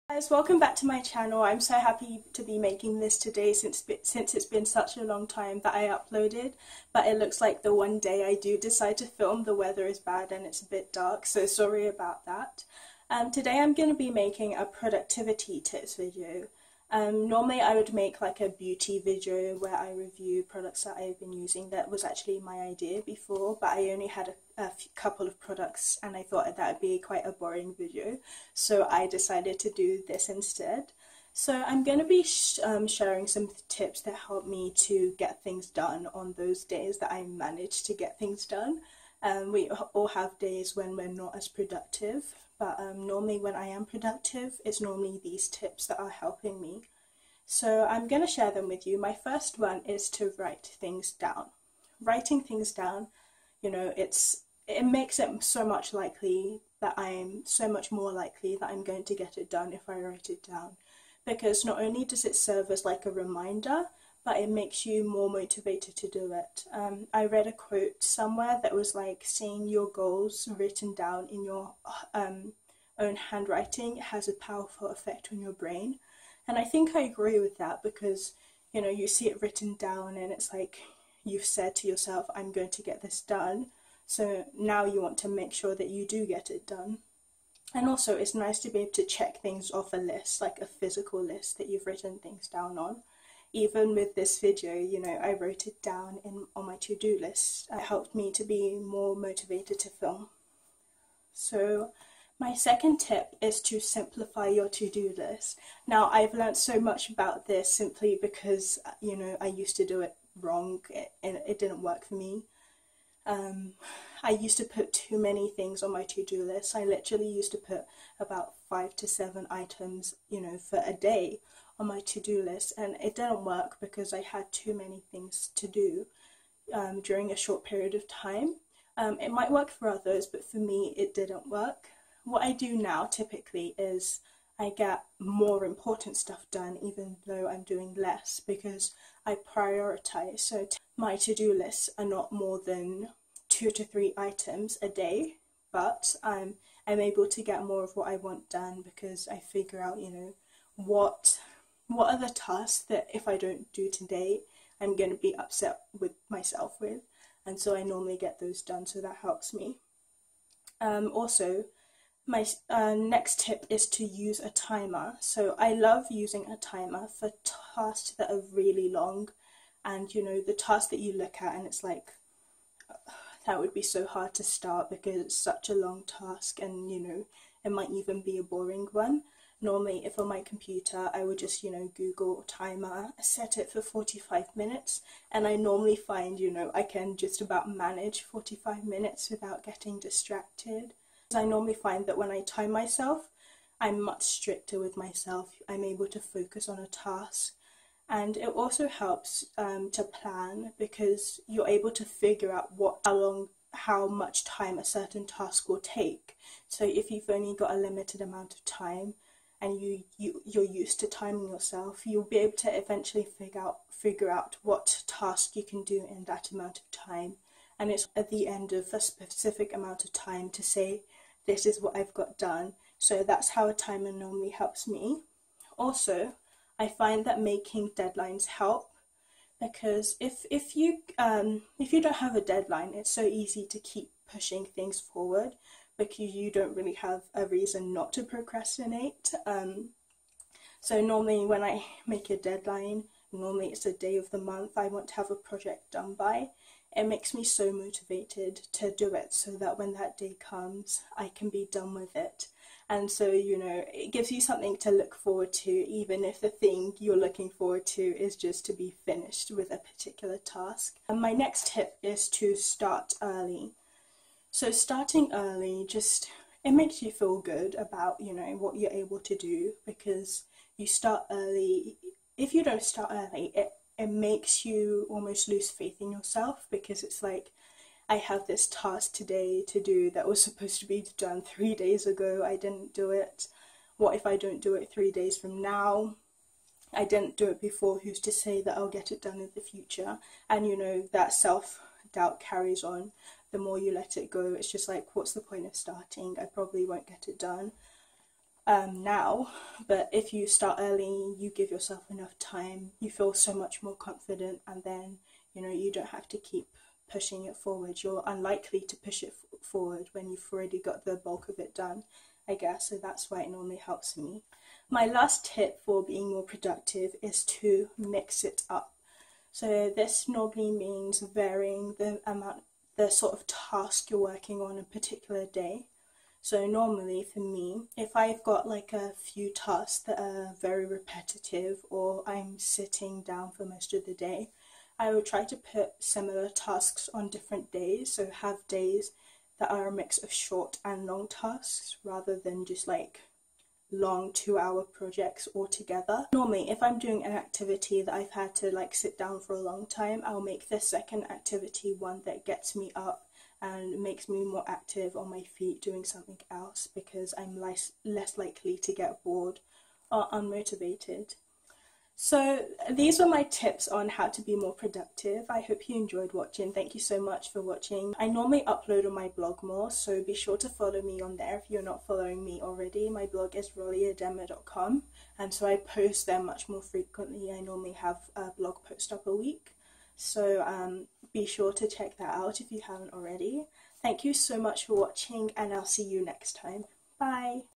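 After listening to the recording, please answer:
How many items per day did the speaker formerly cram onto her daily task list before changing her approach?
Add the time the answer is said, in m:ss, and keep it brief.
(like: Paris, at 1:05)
5 to 7, at 1:58.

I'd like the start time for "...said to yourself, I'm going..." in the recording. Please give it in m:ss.
1:21.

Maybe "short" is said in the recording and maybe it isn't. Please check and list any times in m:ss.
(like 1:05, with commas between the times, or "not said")
2:07, 5:40.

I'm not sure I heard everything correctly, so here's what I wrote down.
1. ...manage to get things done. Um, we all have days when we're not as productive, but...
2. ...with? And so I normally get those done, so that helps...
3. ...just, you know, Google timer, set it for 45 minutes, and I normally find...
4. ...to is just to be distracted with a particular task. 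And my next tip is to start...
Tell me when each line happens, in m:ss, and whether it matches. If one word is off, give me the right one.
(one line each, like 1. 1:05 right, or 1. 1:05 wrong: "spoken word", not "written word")
1. 0:37 right
2. 2:36 right
3. 3:01 right
4. 4:17 wrong: "finished", not "distracted".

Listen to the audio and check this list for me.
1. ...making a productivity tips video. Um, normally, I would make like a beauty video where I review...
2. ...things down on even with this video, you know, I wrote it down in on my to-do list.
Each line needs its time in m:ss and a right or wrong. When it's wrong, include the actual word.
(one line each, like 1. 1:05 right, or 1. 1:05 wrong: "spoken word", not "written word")
1. 0:14 right
2. 1:32 right.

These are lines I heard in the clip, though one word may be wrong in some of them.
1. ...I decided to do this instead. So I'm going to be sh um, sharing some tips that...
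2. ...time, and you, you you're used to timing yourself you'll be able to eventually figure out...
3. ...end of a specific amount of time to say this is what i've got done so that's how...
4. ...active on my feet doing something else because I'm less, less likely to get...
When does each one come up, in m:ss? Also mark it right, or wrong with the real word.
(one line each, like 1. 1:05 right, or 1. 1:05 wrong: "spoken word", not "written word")
1. 0:28 right
2. 3:28 right
3. 3:38 right
4. 5:54 right.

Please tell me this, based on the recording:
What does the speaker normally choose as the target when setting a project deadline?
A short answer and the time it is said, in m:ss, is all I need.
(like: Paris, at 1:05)
a day of the month, at 4:03.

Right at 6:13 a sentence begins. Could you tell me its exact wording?
My blog is roliedema.com, and so I post there much more frequently.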